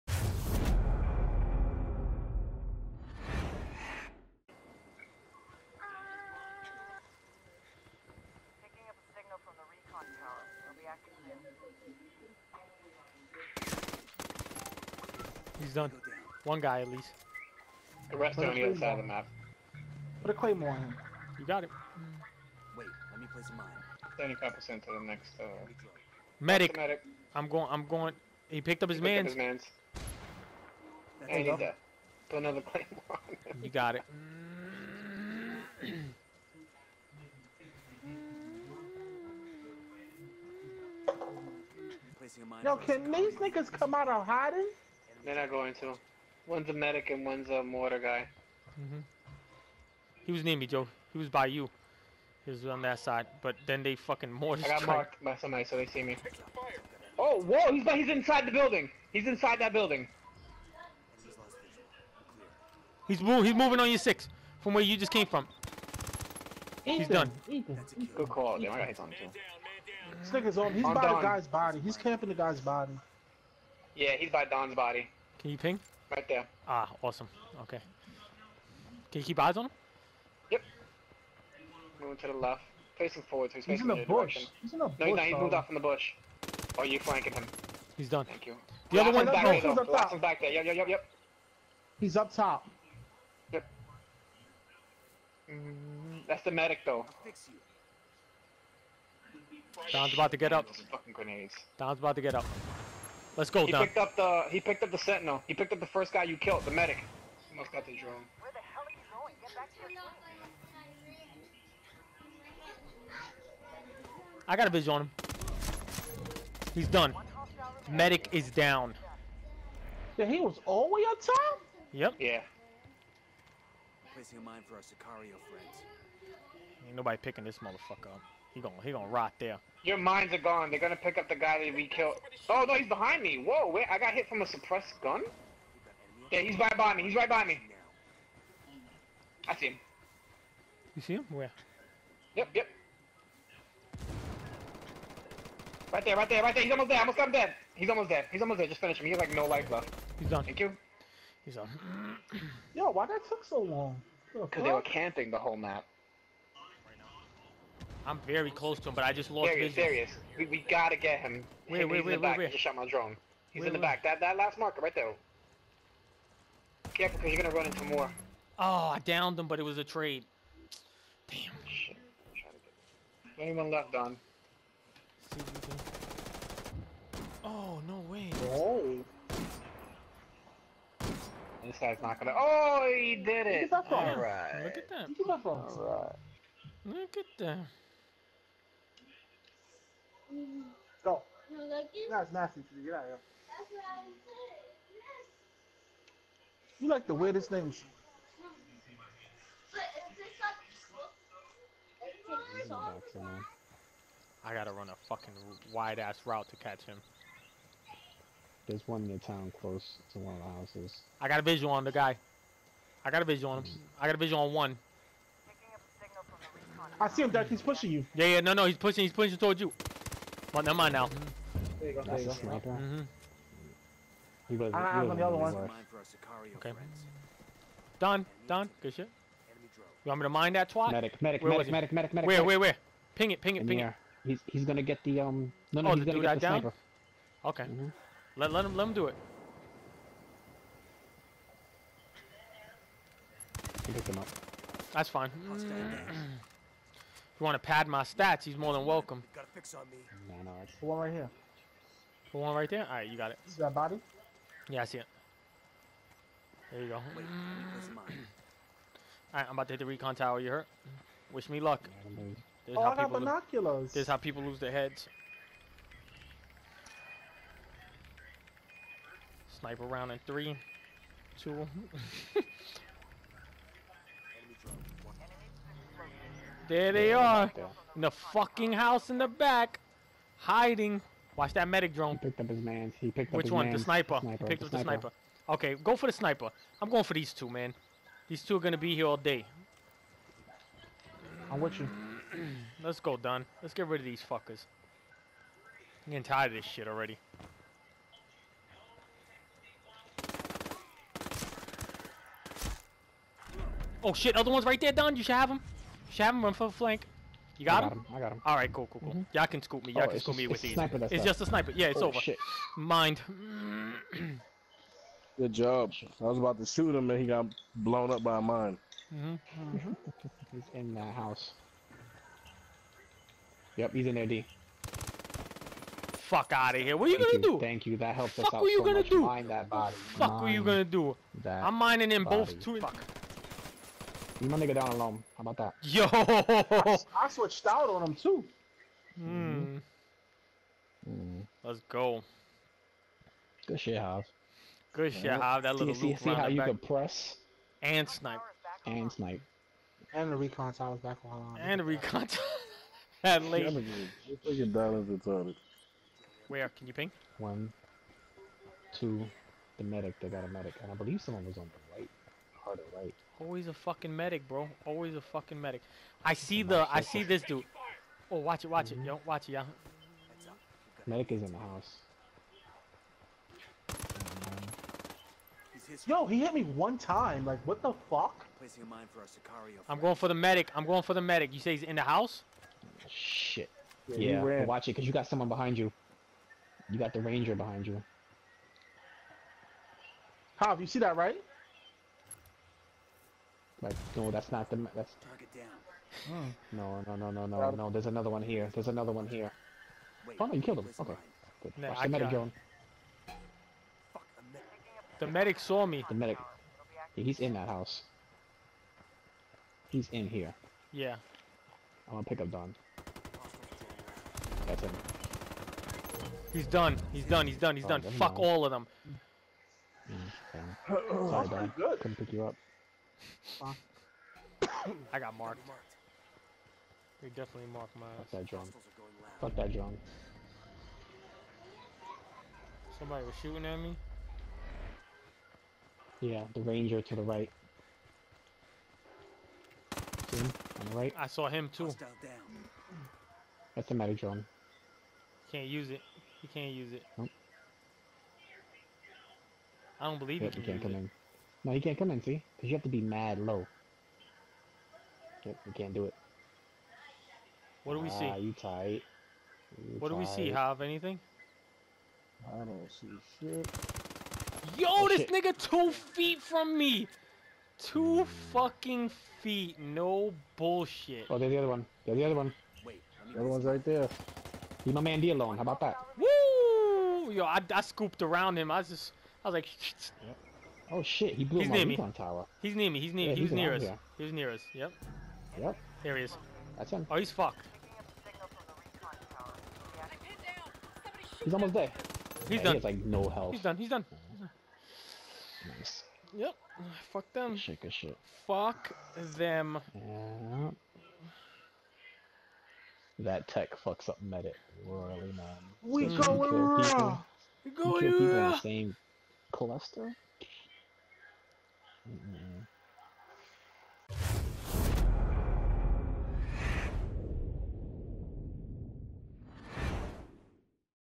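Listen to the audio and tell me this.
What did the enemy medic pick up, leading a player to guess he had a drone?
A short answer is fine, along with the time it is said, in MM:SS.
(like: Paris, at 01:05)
The sentinel, at 01:44.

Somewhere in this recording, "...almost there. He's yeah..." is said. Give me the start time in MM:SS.
08:11.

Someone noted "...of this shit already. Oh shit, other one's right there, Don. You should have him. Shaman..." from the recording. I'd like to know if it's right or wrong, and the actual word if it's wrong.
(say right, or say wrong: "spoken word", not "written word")
right.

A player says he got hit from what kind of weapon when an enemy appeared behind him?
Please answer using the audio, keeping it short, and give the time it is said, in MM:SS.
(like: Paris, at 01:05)
Suppressed gun, at 02:14.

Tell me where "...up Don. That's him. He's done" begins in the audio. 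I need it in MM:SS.
06:52.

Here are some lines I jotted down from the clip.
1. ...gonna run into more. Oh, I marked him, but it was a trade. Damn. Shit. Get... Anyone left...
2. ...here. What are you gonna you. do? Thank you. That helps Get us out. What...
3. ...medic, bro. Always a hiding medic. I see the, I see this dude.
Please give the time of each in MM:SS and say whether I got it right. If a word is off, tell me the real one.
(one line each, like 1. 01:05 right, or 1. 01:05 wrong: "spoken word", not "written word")
1. 02:47 wrong: "downed", not "marked"
2. 05:26 wrong: "Fuck", not "Get"
3. 06:04 wrong: "fucking", not "hiding".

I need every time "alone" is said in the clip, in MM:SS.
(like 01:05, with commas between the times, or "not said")
05:34, 07:55.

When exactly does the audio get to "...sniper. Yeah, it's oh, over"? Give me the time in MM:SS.
05:11.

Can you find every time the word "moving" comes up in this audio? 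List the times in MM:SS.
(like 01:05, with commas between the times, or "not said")
01:03, 01:21.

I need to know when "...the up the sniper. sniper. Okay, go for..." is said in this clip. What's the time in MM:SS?
04:44.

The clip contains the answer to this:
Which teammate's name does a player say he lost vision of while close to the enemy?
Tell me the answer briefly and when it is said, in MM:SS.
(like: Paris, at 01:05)
Darius, at 02:39.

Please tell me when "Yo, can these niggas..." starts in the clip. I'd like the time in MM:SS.
00:42.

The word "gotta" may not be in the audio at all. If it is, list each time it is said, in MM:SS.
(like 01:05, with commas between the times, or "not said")
02:40, 03:24.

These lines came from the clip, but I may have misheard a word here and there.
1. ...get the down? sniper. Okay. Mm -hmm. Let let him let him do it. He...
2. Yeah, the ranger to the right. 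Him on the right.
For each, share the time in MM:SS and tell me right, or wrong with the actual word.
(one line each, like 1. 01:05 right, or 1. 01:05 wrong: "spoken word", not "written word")
1. 03:56 right
2. 07:16 right.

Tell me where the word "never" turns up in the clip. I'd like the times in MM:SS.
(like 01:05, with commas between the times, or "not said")
03:40.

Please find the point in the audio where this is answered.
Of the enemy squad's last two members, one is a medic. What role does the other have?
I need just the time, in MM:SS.
00:47.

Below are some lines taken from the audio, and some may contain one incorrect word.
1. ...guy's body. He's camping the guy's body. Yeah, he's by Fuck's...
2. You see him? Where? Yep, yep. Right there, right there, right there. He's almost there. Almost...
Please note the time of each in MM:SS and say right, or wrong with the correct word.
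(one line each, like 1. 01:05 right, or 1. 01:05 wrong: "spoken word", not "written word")
1. 01:11 wrong: "Don", not "Fuck"
2. 02:20 right.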